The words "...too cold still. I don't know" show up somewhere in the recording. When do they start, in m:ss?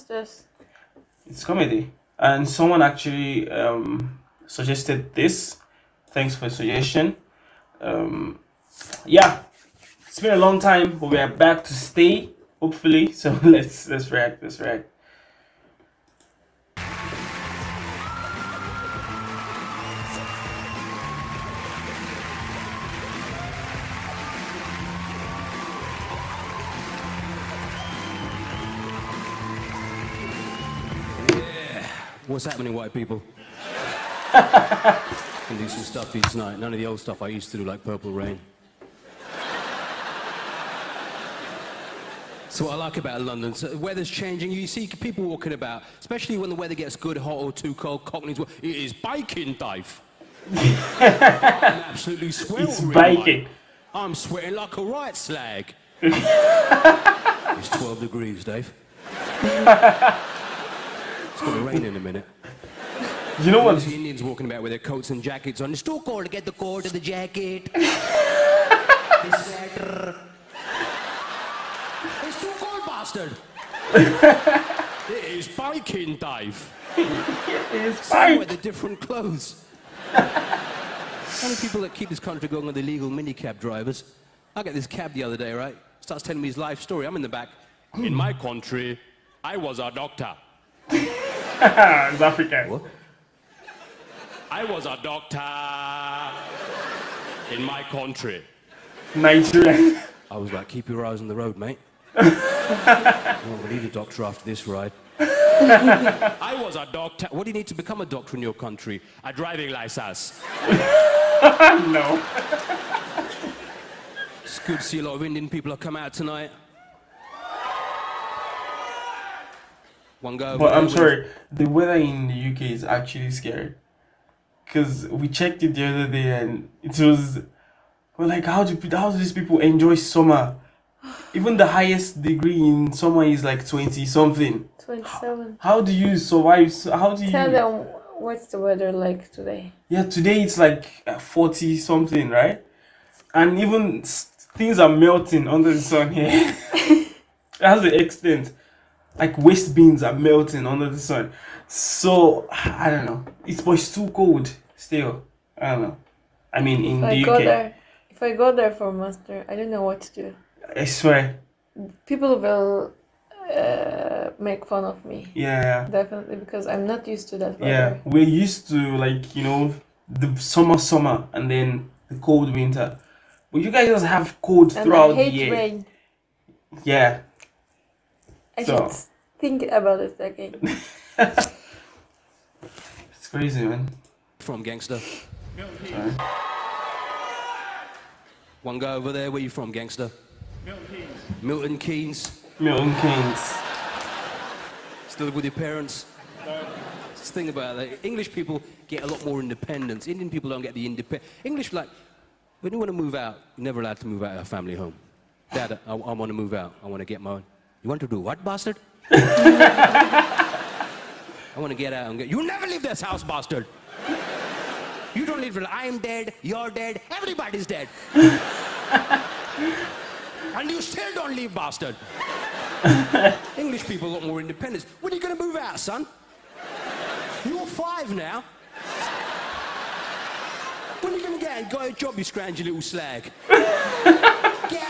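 2:33.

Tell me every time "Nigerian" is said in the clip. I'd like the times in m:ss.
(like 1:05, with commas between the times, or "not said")
1:39.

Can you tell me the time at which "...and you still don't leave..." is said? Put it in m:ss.
3:38.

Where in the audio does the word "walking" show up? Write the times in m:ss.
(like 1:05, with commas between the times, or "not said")
0:45, 1:04.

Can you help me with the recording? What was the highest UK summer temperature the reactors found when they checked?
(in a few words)
27.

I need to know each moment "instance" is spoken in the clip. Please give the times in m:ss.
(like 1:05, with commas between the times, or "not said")
not said.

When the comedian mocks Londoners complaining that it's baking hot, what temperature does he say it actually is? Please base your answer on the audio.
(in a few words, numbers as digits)
12 degrees.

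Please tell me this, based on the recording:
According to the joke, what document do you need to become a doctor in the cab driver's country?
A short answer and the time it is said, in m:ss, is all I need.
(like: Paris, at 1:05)
A driving license, at 1:49.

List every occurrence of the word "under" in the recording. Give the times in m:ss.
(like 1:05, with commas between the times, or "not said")
2:25, 2:30.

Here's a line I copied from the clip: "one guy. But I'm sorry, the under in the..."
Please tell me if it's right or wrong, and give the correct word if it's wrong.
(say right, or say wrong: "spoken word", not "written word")
wrong: "weather", not "under".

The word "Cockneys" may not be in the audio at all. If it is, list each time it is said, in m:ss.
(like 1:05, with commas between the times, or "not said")
0:48.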